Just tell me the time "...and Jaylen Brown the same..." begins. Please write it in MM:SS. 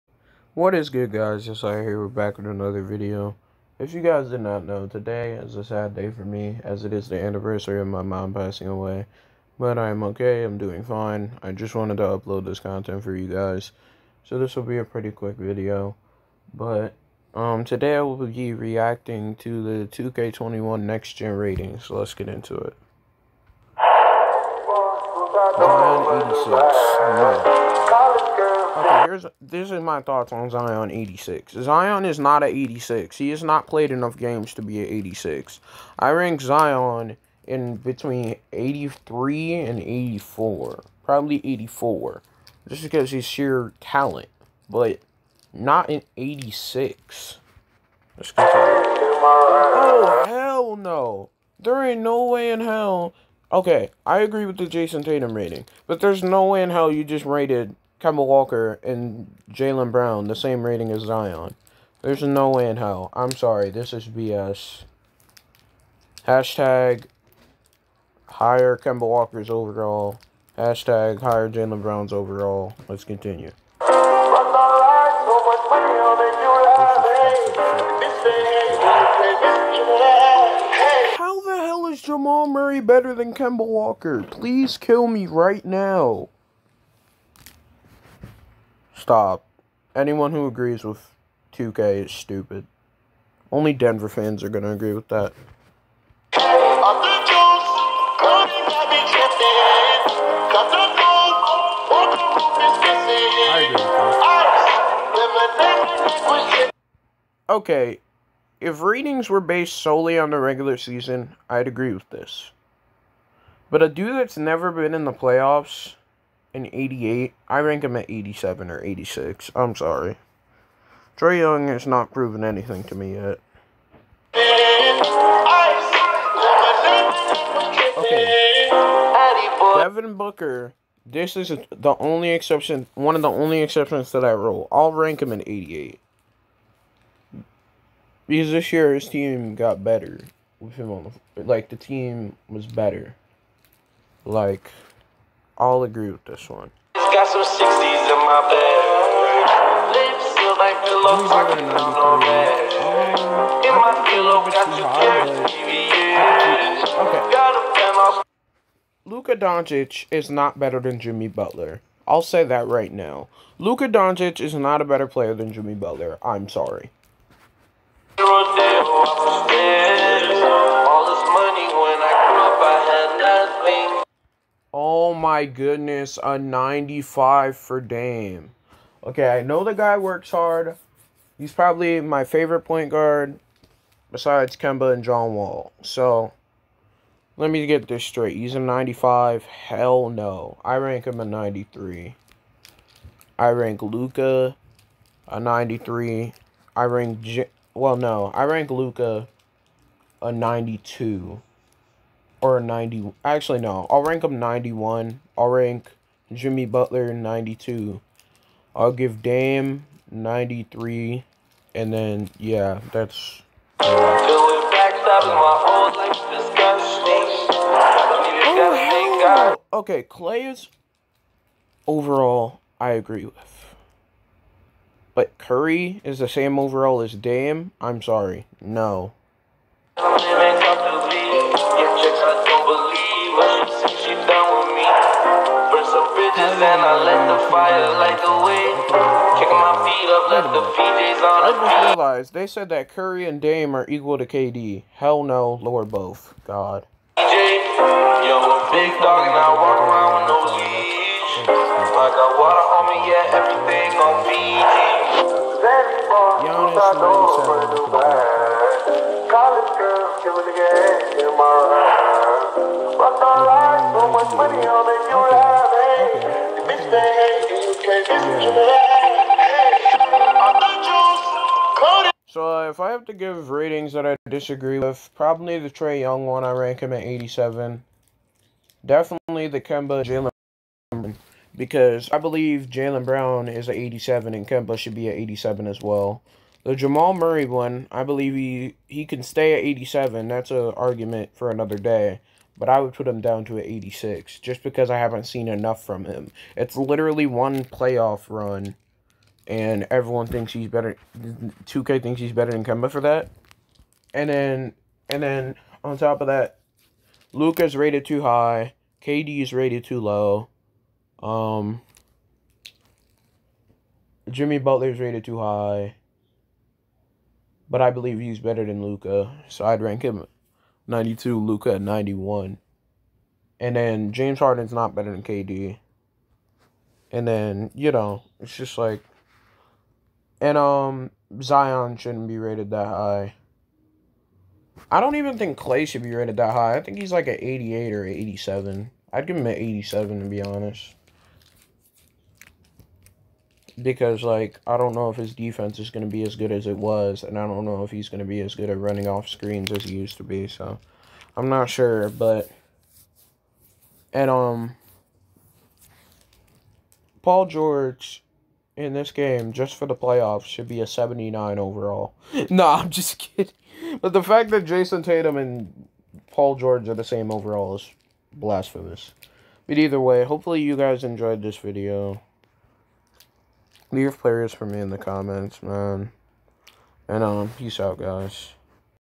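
00:58.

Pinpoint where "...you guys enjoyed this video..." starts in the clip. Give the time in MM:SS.
06:10.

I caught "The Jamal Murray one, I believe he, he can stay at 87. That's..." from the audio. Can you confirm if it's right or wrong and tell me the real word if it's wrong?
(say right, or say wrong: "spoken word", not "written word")
right.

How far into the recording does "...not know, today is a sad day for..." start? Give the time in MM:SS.
00:04.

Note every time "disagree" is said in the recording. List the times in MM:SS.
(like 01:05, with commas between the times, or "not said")
04:34.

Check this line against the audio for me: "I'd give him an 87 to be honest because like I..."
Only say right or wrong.
right.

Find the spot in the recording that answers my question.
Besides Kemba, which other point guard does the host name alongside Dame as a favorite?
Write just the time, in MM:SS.
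03:05.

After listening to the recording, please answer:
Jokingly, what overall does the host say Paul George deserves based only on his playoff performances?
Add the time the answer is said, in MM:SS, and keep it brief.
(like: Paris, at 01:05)
79, at 06:00.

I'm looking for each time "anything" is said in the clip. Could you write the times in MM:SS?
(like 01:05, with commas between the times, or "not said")
02:02.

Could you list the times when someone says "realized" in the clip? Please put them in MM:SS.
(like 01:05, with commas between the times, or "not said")
04:01.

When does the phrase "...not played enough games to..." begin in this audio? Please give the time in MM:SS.
00:33.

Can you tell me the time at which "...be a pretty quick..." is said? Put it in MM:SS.
00:14.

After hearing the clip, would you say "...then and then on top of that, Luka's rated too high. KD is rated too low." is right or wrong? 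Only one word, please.
right.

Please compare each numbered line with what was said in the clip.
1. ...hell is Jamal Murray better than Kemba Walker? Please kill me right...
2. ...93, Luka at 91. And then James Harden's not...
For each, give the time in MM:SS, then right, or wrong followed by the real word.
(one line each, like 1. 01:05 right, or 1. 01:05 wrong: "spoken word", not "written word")
1. 01:21 right
2. 05:20 wrong: "92", not "93".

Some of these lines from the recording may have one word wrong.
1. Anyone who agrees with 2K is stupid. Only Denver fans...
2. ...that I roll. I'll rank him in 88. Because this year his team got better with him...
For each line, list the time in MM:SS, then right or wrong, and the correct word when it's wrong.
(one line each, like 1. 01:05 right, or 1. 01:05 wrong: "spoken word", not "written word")
1. 01:29 right
2. 02:14 right.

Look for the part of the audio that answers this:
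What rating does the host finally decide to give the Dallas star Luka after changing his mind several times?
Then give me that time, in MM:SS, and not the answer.
03:23.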